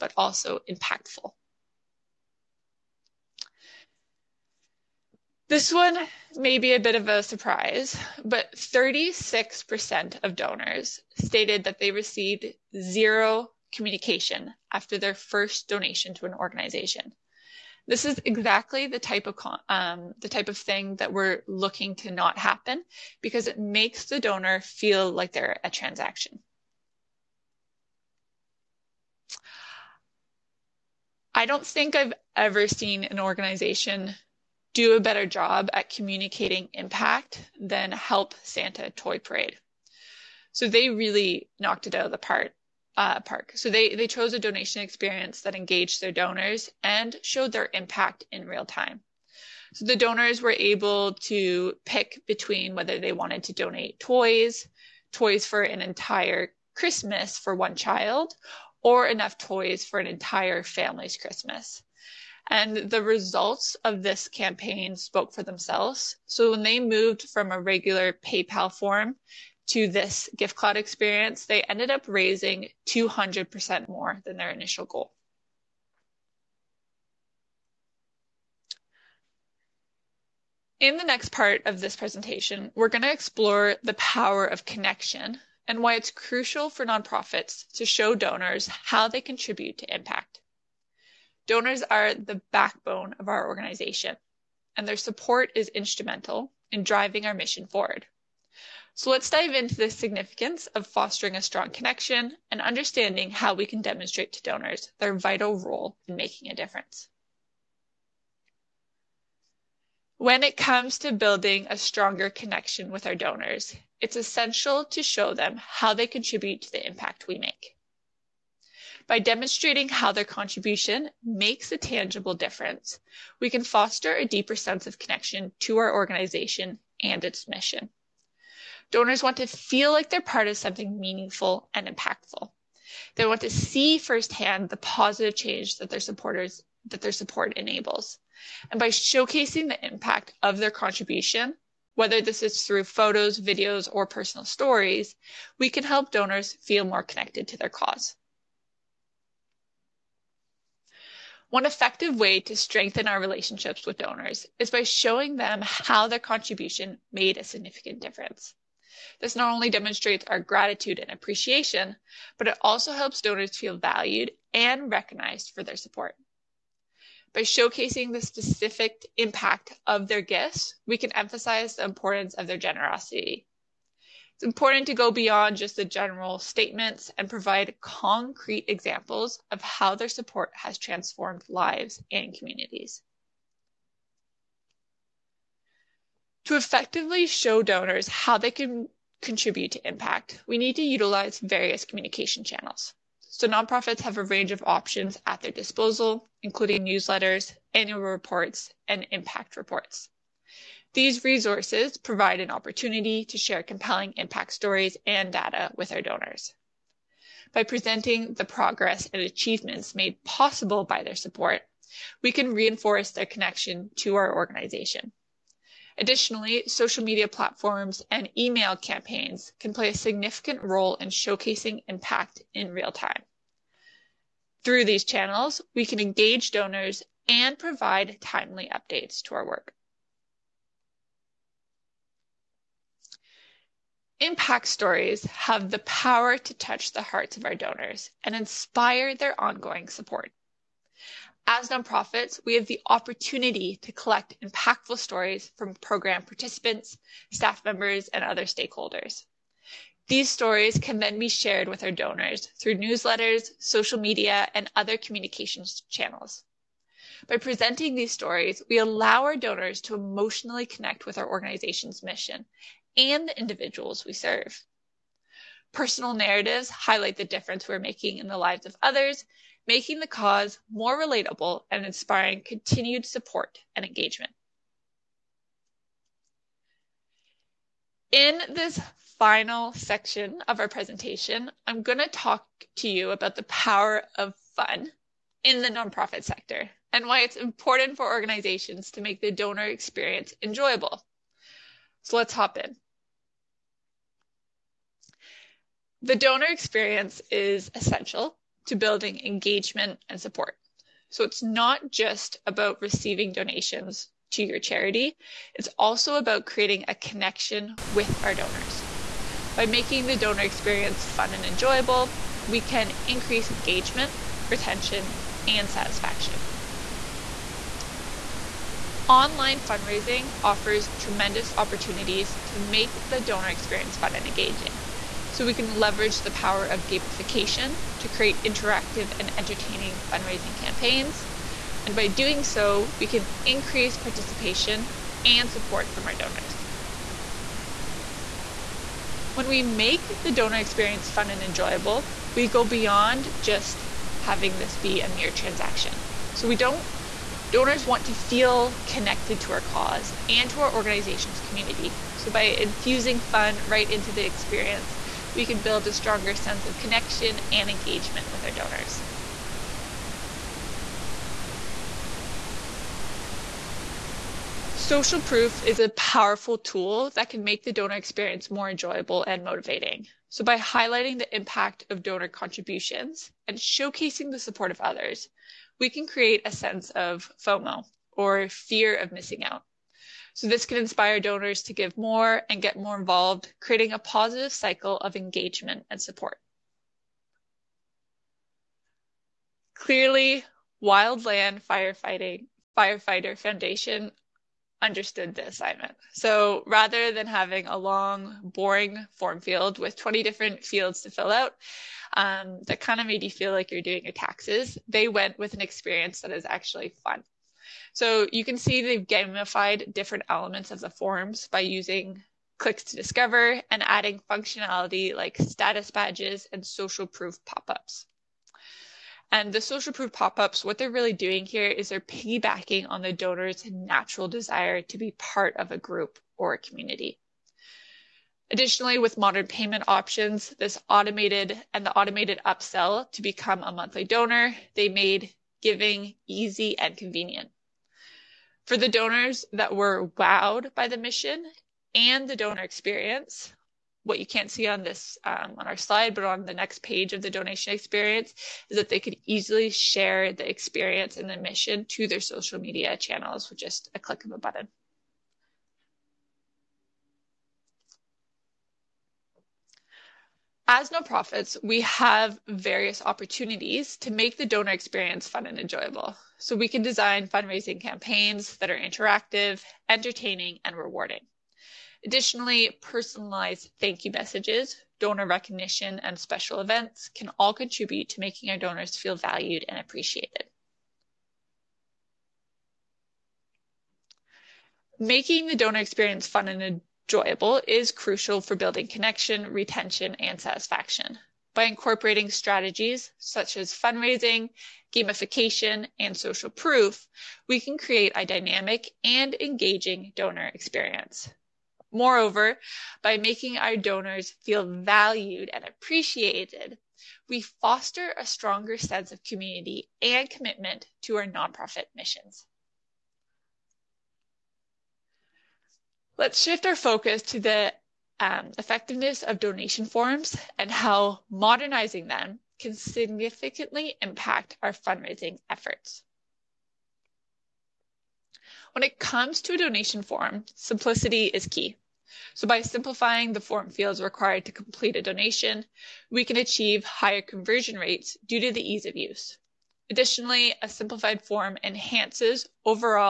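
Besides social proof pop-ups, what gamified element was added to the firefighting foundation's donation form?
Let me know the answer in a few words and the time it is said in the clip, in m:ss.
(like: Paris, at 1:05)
status badges, at 6:55.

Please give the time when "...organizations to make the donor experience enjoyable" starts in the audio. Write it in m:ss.
4:48.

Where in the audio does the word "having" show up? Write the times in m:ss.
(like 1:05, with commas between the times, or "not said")
5:44, 6:37.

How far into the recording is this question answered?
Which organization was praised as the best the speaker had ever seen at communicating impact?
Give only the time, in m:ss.
0:37.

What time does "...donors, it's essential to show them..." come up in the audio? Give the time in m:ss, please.
1:53.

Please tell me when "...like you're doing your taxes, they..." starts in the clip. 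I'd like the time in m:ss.
6:43.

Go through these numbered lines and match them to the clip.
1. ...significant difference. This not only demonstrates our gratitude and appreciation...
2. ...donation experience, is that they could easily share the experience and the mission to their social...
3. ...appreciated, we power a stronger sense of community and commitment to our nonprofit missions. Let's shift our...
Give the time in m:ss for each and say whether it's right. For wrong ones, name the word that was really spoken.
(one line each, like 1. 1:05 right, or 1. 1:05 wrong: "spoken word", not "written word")
1. 2:37 right
2. 7:27 right
3. 8:25 wrong: "foster", not "power".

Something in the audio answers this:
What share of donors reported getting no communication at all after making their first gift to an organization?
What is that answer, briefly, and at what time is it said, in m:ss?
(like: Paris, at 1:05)
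36%, at 0:08.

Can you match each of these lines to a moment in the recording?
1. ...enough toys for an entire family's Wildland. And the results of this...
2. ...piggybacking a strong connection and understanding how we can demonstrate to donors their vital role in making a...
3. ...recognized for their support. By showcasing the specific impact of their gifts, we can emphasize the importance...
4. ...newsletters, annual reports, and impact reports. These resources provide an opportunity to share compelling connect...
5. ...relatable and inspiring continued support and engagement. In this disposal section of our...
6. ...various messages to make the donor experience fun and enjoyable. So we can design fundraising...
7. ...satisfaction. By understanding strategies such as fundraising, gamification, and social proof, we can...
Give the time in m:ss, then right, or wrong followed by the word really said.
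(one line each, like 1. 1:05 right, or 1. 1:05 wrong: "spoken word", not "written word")
1. 0:59 wrong: "Christmas", not "Wildland"
2. 1:40 wrong: "fostering", not "piggybacking"
3. 2:44 right
4. 3:16 wrong: "impact", not "connect"
5. 4:30 wrong: "final", not "disposal"
6. 7:42 wrong: "opportunities", not "messages"
7. 8:10 wrong: "incorporating", not "understanding".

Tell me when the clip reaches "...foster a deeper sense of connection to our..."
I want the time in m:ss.
2:03.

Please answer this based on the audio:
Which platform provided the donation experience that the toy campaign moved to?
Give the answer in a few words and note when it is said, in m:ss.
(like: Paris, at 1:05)
GiveCloud, at 1:10.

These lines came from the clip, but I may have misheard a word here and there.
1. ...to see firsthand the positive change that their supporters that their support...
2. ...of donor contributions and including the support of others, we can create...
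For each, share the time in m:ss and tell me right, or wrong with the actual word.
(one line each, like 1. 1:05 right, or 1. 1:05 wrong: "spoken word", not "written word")
1. 2:13 right
2. 6:11 wrong: "showcasing", not "including".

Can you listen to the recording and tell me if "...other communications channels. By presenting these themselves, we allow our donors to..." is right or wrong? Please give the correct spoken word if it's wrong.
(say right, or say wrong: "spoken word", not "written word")
wrong: "stories", not "themselves".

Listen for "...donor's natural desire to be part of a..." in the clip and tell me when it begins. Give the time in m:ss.
7:03.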